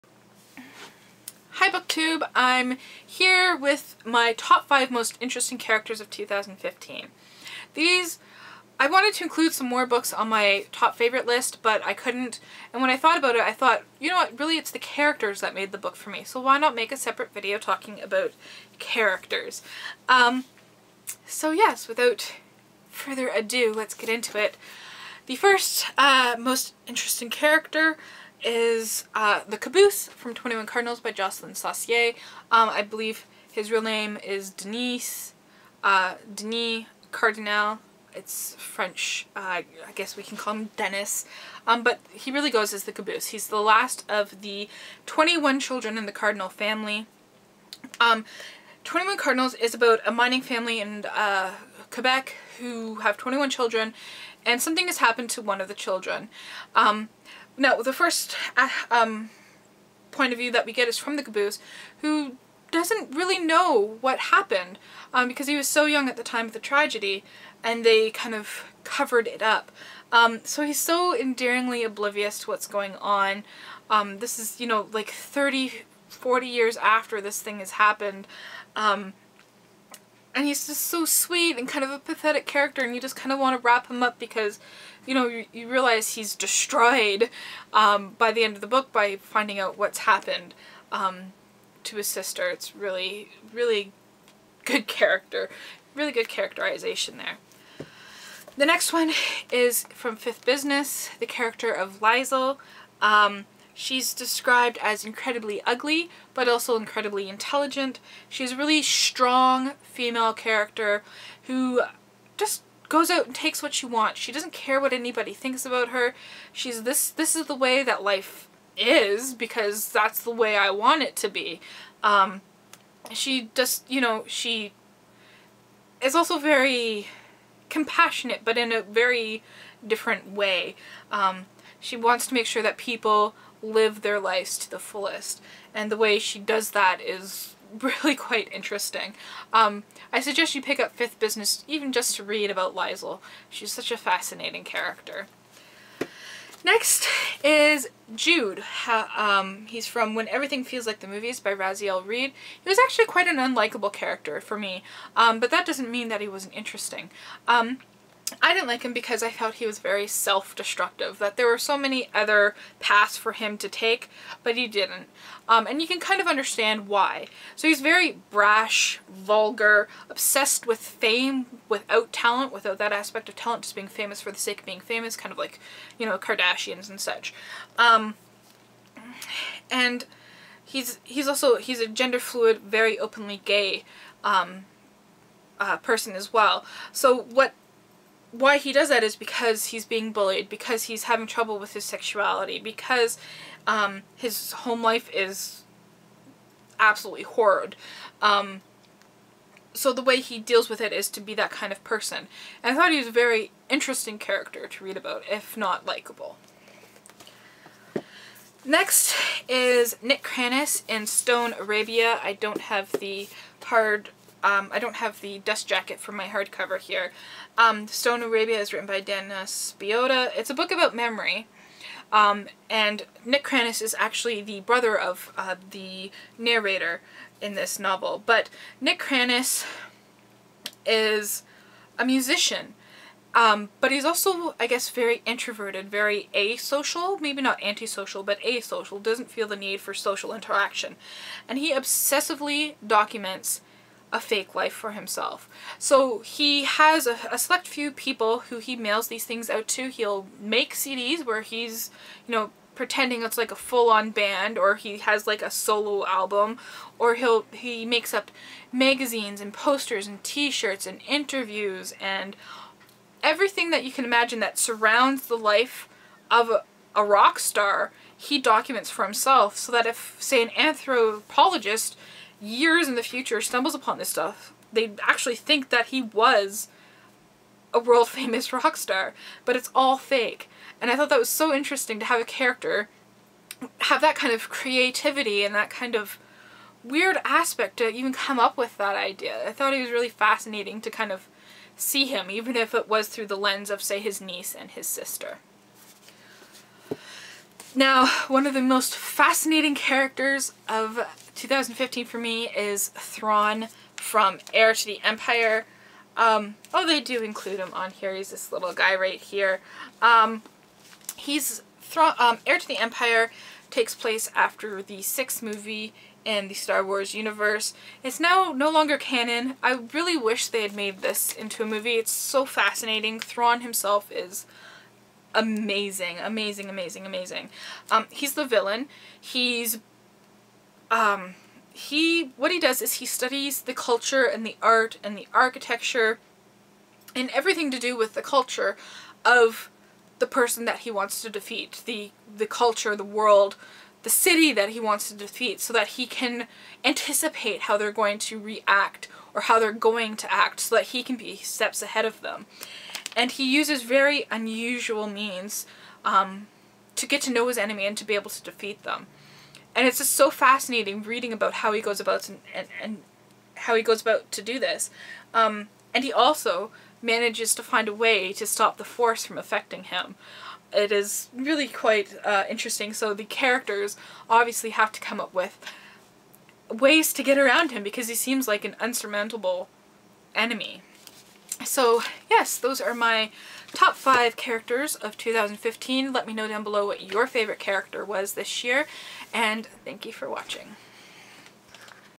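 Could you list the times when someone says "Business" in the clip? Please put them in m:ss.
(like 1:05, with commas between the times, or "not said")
1:40, 2:21.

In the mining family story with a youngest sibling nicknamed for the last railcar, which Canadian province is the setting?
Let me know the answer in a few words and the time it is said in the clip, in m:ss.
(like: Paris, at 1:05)
Quebec, at 0:51.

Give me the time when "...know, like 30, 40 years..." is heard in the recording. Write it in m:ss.
1:14.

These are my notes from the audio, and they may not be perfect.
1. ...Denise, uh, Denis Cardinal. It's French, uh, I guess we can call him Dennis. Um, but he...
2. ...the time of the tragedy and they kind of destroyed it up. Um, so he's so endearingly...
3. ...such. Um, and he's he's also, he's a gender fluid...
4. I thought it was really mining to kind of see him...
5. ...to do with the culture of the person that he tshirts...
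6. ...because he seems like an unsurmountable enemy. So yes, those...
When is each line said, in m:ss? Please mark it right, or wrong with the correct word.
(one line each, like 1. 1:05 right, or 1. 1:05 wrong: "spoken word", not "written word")
1. 0:34 right
2. 1:06 wrong: "covered", not "destroyed"
3. 2:57 right
4. 4:49 wrong: "fascinating", not "mining"
5. 5:37 wrong: "wants", not "tshirts"
6. 6:17 right.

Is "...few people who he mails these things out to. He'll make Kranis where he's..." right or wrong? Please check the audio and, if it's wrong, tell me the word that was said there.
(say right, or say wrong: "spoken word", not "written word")
wrong: "CDs", not "Kranis".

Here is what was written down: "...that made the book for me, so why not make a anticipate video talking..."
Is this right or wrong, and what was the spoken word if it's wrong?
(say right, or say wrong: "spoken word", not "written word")
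wrong: "separate", not "anticipate".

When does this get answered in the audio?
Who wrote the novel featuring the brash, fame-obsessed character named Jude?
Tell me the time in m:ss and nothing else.
2:31.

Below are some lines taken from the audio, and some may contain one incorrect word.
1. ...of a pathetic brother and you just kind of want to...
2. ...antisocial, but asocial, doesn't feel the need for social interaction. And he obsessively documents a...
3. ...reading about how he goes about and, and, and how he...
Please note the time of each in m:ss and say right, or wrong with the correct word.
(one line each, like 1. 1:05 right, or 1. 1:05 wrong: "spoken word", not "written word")
1. 1:21 wrong: "character", not "brother"
2. 3:57 right
3. 6:01 right.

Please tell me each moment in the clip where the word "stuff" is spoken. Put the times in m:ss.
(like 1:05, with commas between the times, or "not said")
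4:34.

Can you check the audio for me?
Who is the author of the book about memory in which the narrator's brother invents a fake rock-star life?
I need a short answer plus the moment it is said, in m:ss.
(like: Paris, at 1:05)
Dana Spiotta, at 3:39.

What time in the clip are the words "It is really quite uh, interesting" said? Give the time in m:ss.
6:10.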